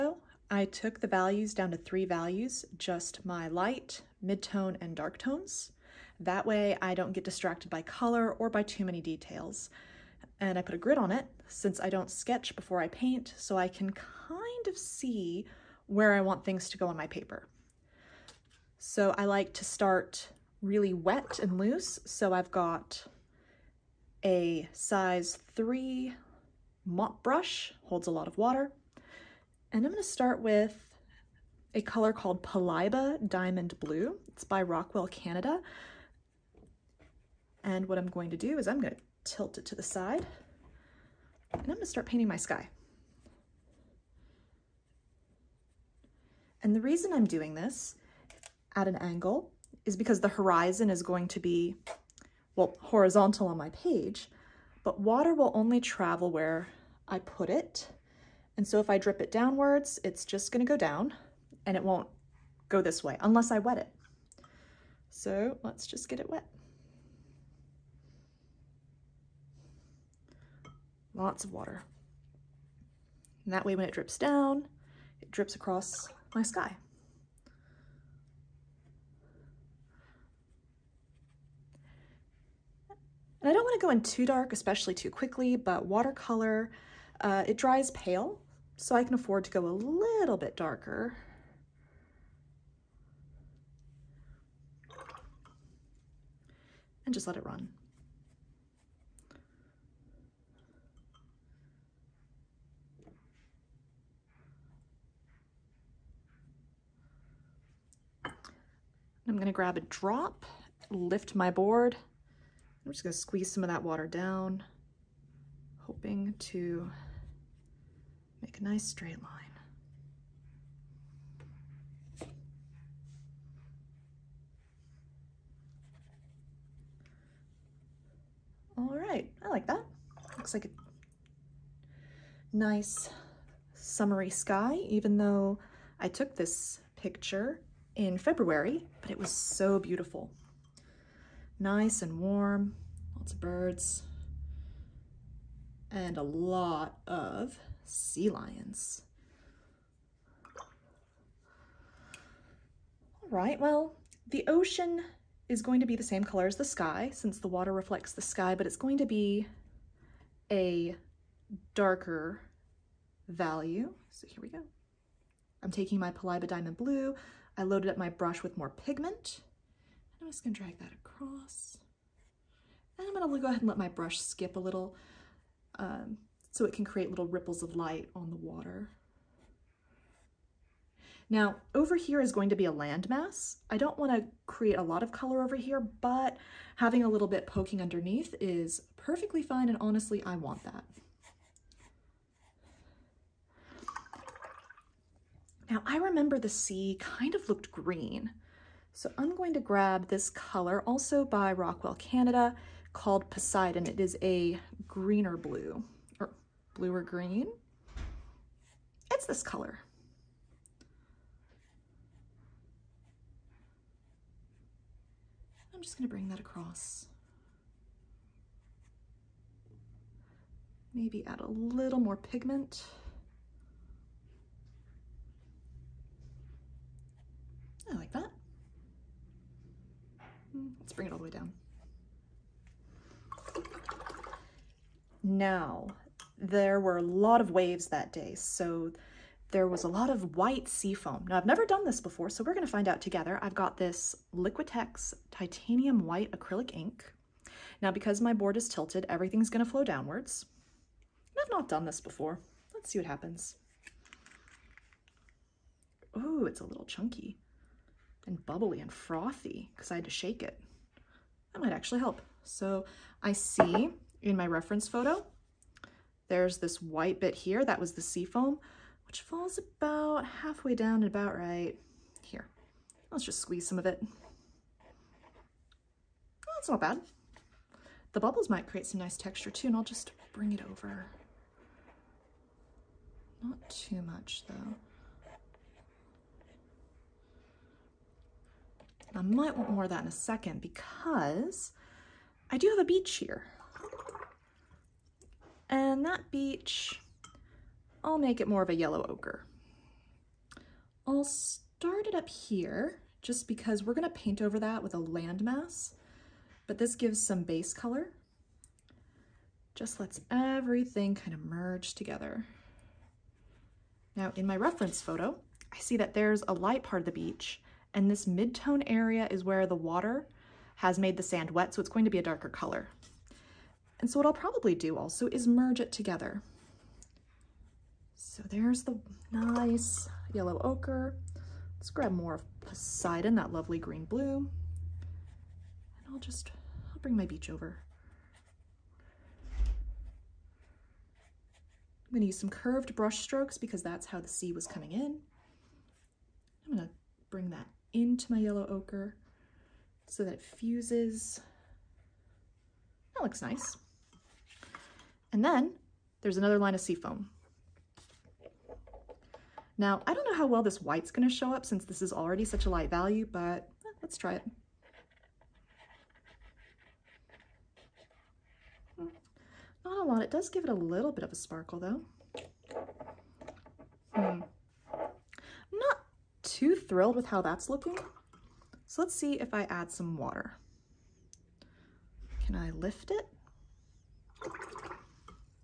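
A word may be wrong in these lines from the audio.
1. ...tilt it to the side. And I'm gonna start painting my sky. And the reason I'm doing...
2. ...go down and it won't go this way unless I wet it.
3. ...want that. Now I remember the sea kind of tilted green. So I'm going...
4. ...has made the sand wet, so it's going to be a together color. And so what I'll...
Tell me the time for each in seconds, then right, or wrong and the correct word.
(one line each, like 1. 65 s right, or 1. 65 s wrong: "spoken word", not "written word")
1. 39 s right
2. 60 s right
3. 190 s wrong: "looked", not "tilted"
4. 320 s wrong: "darker", not "together".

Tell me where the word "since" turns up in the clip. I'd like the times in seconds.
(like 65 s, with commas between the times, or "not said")
11 s, 157 s, 361 s.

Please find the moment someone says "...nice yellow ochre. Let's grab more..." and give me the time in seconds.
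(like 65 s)
329 s.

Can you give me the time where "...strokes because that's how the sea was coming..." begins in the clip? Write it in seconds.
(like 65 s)
343 s.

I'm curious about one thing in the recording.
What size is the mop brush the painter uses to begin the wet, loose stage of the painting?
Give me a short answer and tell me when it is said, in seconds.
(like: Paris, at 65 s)
3, at 24 s.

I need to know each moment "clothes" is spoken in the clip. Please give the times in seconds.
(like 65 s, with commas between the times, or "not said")
not said.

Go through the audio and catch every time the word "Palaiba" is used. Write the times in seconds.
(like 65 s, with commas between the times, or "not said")
32 s, 166 s.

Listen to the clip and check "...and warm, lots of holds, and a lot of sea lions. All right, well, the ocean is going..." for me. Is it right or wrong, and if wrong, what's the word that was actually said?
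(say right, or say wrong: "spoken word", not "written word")
wrong: "birds", not "holds".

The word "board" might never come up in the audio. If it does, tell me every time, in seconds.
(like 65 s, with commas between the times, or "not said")
111 s, 248 s.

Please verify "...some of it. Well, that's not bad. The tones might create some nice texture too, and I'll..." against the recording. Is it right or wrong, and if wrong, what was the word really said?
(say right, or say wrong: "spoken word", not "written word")
wrong: "bubbles", not "tones".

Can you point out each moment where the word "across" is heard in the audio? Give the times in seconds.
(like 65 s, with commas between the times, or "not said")
75 s, 170 s, 216 s.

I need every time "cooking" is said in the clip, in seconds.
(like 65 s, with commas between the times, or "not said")
not said.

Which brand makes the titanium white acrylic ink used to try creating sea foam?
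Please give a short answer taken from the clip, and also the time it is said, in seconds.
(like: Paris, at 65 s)
Liquitex, at 244 s.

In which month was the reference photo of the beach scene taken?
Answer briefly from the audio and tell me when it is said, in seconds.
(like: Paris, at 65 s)
February, at 138 s.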